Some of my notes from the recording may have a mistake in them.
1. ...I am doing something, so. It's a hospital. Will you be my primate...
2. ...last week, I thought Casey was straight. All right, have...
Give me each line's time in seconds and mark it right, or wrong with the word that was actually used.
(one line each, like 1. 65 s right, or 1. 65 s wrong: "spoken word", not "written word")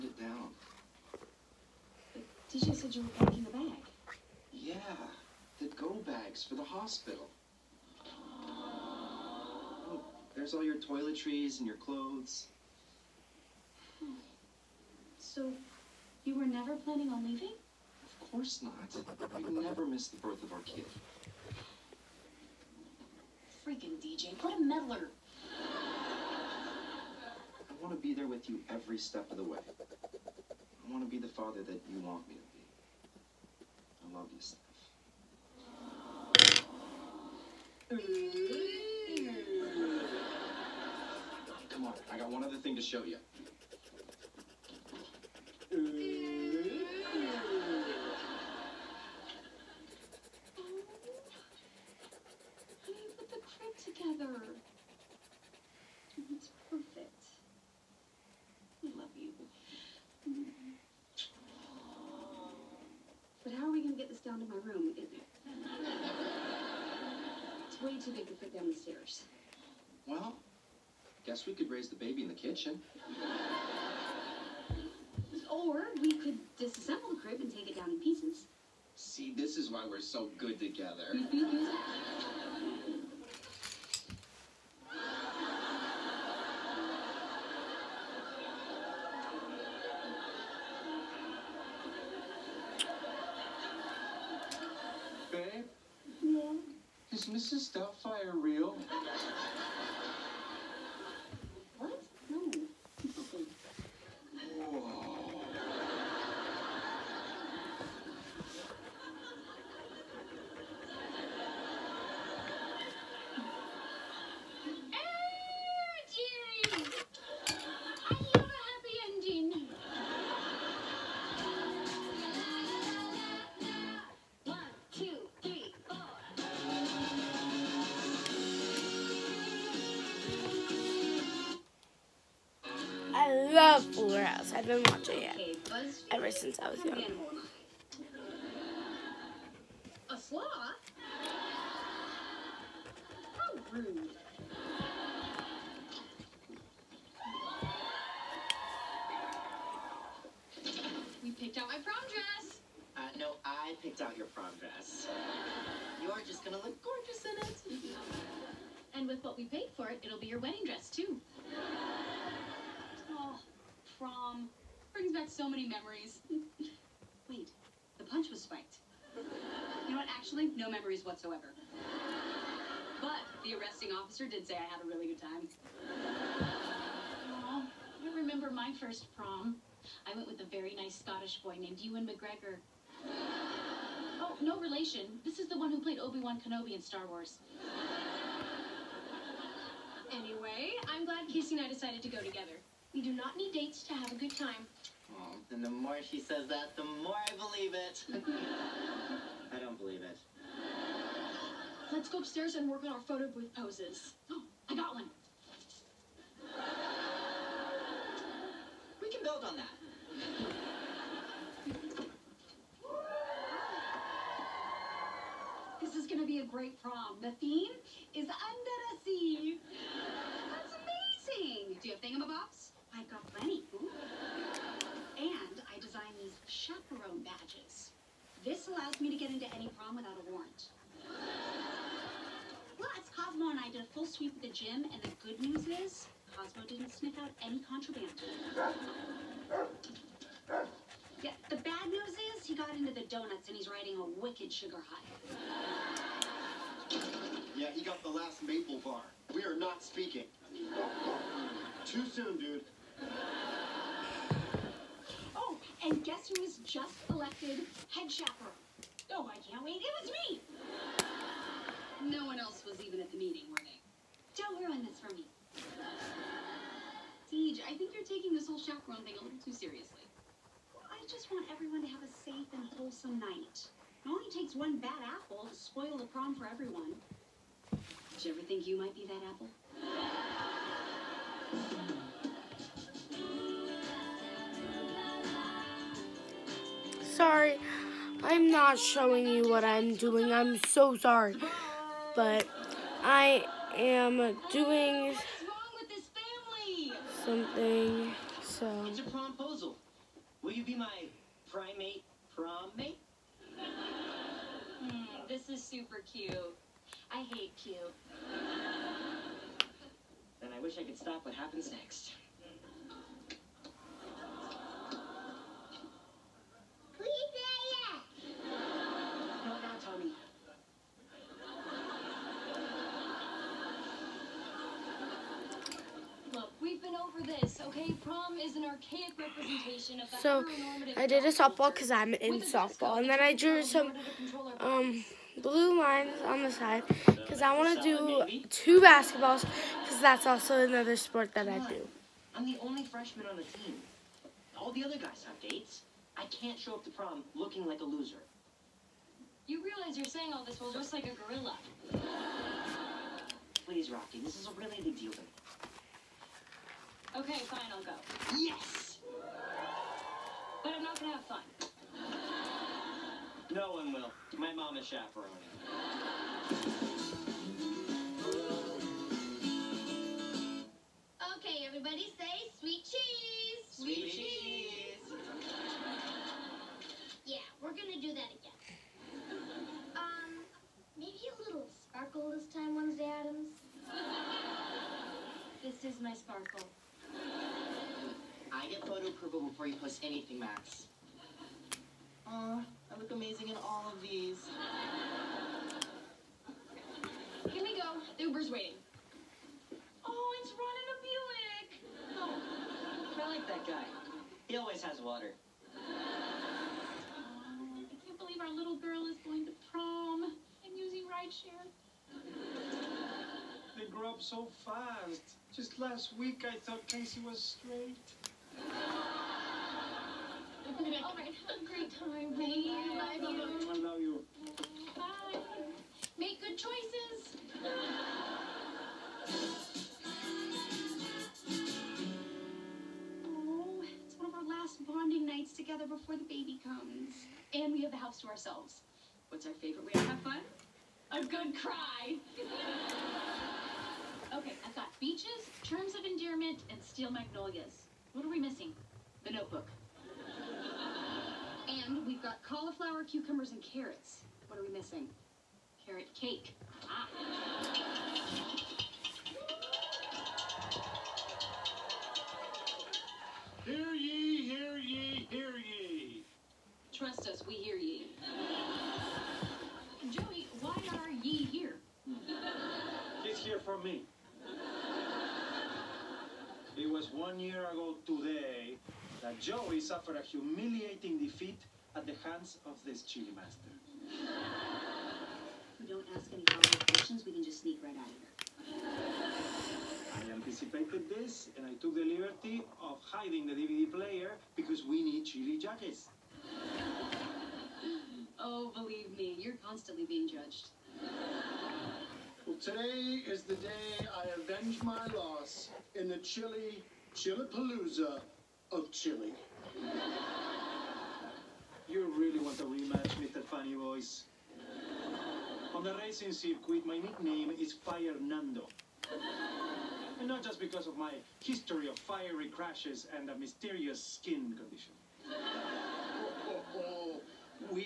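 1. 293 s wrong: "promposal", not "hospital"
2. 415 s right.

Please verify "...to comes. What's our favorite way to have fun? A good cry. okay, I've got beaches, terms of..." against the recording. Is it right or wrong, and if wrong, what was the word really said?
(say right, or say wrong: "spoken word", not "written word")
wrong: "ourselves", not "comes".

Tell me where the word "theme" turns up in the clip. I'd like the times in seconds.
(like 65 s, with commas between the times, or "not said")
217 s.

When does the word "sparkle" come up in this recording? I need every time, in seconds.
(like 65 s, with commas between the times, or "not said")
381 s, 386 s.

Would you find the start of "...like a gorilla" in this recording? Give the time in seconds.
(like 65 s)
350 s.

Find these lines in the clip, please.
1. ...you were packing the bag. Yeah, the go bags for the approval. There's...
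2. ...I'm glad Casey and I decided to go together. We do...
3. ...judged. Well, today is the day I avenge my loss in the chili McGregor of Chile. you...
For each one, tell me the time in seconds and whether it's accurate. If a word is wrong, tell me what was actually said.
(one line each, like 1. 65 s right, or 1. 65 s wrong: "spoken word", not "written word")
1. 2 s wrong: "hospital", not "approval"
2. 190 s right
3. 500 s wrong: "Chillapalooza", not "McGregor".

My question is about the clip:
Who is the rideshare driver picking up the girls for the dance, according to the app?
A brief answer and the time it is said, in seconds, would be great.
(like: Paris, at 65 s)
Ron, at 400 s.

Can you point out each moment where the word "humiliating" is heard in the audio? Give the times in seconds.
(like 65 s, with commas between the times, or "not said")
480 s.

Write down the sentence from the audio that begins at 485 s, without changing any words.
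We don't ask any follow-up questions, we can just sneak right out of here.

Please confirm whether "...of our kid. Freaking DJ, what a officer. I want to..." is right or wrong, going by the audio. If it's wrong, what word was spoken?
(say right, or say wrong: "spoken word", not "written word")
wrong: "meddler", not "officer".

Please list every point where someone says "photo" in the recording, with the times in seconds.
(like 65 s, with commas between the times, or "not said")
203 s, 388 s.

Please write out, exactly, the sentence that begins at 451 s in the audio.
and we've got cauliflower, cucumbers, and carrots.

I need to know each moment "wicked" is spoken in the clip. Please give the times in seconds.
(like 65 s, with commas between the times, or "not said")
244 s.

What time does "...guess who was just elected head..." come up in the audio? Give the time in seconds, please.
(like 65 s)
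256 s.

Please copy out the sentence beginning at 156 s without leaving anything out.
You're just gonna look gorgeous in it.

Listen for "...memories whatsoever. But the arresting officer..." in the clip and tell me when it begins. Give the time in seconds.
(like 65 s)
170 s.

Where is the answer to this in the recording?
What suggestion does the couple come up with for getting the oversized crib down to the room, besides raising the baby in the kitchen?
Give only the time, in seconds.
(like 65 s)
76 s.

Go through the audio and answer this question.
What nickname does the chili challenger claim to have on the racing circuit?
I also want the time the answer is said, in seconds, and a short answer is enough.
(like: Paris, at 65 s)
Fire Nando, at 517 s.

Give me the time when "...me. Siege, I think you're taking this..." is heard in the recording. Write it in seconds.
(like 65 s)
265 s.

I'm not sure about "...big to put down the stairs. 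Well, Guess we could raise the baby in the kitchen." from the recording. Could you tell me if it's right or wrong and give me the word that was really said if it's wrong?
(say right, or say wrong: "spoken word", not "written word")
right.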